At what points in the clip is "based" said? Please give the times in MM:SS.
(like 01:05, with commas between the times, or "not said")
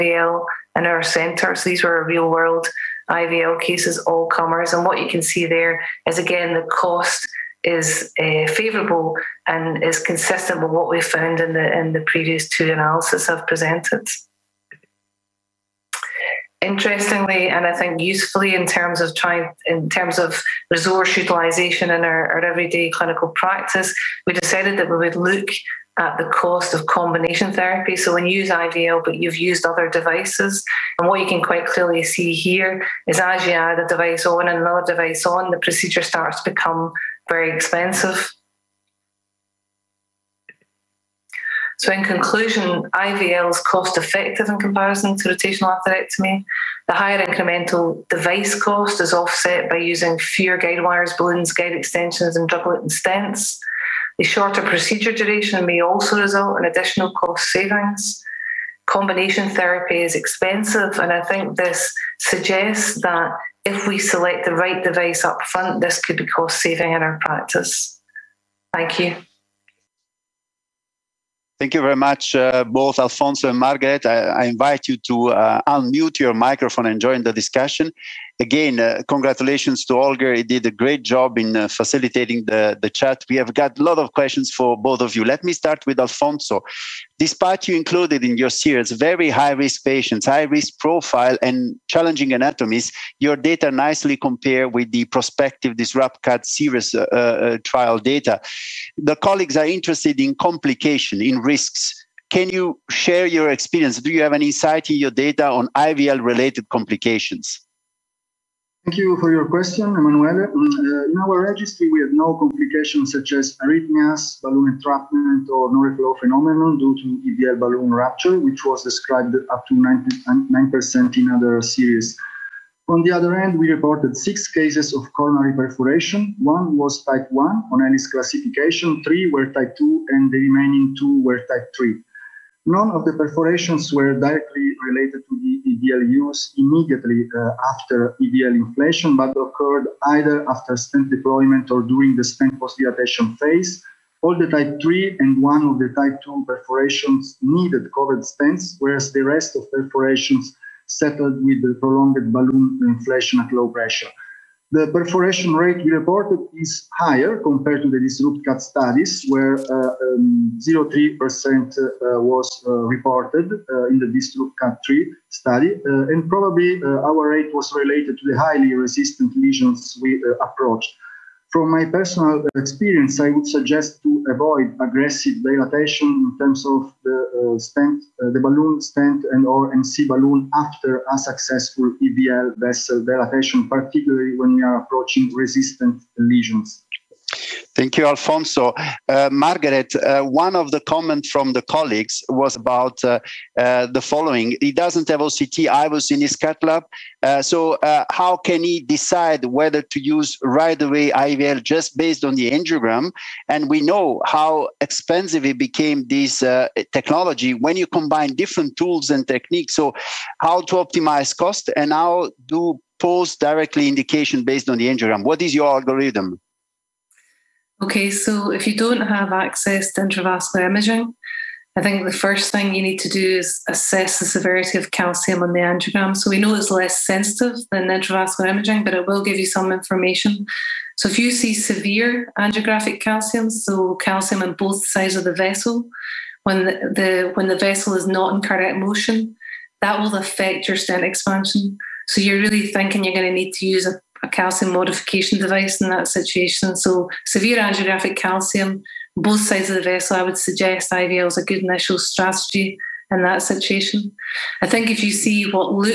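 03:21, 03:34.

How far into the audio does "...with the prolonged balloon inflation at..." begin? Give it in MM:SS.
02:31.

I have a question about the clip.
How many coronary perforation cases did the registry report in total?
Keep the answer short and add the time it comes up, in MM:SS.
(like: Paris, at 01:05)
6, at 02:04.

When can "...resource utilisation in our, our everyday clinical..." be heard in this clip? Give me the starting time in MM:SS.
00:20.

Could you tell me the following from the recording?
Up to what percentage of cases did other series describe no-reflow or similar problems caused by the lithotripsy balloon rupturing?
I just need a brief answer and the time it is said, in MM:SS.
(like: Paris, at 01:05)
9%, at 01:59.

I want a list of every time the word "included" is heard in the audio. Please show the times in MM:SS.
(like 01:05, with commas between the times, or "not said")
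01:27.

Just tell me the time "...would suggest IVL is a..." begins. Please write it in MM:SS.
04:10.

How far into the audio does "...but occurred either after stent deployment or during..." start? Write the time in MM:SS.
02:19.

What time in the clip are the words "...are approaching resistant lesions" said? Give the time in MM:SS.
03:04.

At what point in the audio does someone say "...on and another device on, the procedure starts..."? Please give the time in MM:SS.
00:34.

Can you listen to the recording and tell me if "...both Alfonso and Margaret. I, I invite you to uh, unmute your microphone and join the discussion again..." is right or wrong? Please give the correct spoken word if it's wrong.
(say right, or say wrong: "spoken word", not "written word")
right.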